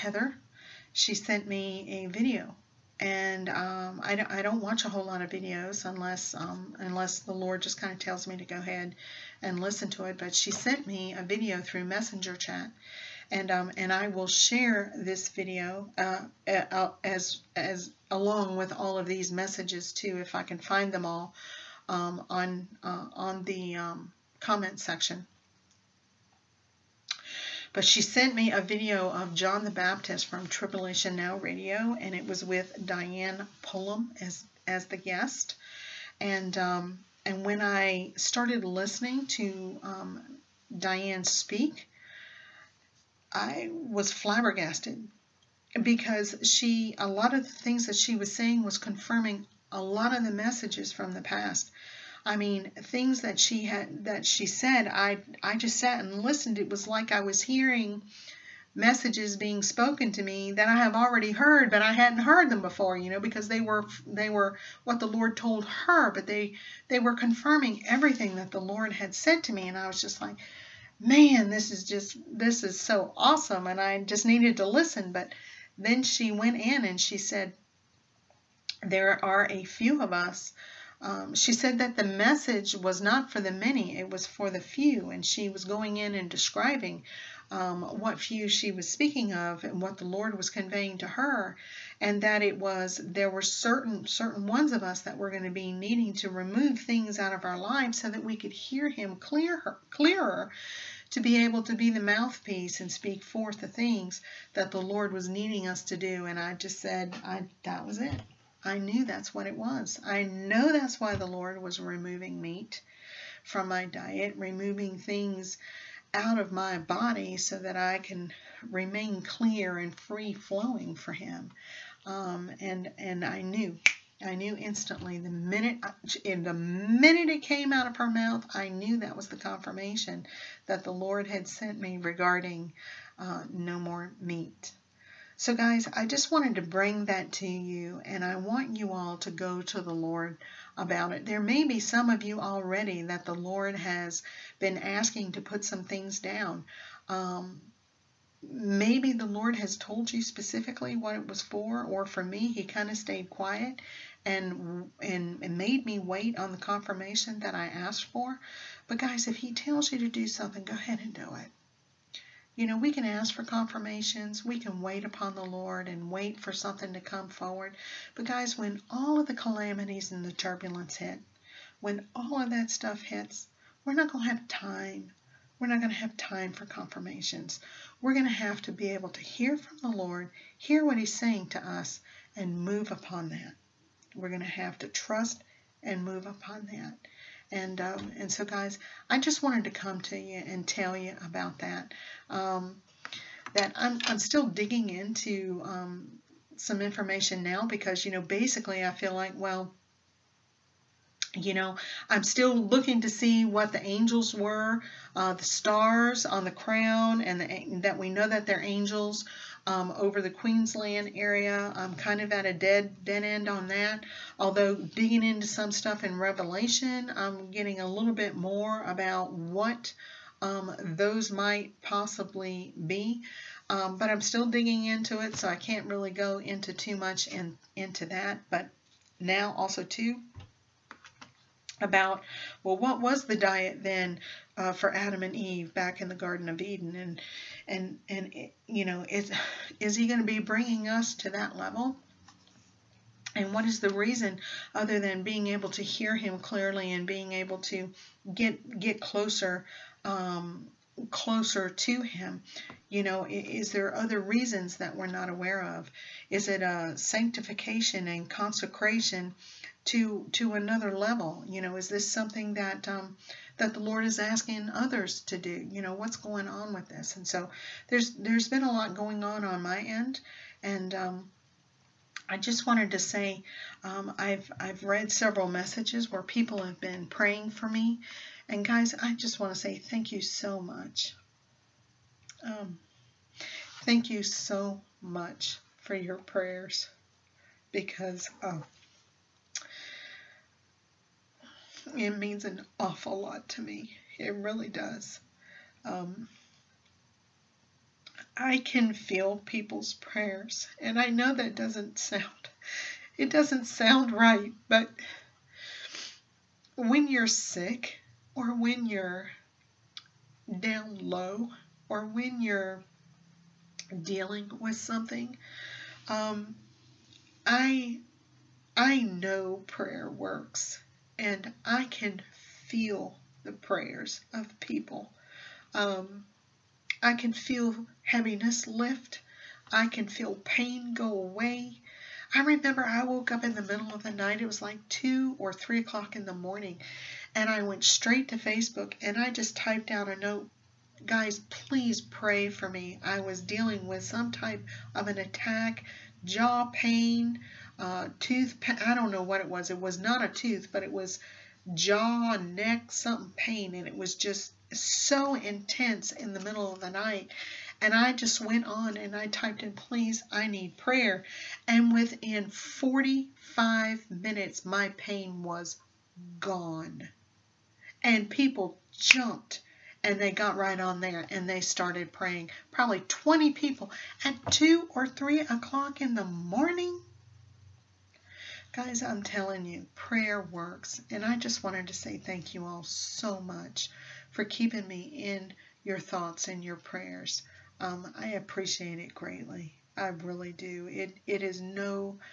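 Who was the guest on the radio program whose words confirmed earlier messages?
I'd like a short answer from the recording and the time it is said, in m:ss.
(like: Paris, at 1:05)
Diane Pullum, at 0:32.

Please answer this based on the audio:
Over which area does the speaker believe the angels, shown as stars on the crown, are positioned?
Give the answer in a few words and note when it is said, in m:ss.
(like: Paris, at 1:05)
Queensland, at 3:30.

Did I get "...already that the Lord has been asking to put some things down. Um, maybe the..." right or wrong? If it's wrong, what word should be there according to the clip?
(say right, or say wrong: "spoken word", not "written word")
right.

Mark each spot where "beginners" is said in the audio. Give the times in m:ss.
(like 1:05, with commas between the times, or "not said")
not said.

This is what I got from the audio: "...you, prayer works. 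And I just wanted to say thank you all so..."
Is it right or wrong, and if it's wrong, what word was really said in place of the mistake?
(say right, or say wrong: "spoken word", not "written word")
right.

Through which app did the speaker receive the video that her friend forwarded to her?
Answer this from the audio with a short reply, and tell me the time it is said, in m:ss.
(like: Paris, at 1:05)
Messenger, at 0:11.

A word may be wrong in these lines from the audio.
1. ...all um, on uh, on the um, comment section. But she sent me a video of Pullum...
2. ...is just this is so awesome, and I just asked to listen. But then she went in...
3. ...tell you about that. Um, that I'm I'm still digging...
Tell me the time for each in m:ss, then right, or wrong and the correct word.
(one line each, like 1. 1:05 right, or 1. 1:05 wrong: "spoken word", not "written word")
1. 0:21 wrong: "John", not "Pullum"
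2. 1:11 wrong: "needed", not "asked"
3. 3:10 right.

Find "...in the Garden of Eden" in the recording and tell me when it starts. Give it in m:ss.
3:56.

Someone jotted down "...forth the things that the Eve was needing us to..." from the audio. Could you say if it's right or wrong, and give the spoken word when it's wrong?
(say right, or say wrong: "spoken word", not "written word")
wrong: "Lord", not "Eve".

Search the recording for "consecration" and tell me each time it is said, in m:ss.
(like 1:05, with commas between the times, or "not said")
4:18.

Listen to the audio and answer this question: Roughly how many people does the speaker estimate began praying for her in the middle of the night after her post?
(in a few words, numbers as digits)
20.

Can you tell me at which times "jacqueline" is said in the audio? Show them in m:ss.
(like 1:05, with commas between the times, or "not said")
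not said.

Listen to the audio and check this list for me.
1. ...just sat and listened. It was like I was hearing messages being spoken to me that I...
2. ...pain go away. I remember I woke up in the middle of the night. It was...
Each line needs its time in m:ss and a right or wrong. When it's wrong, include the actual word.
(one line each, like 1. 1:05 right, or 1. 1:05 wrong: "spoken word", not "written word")
1. 0:55 right
2. 5:30 right.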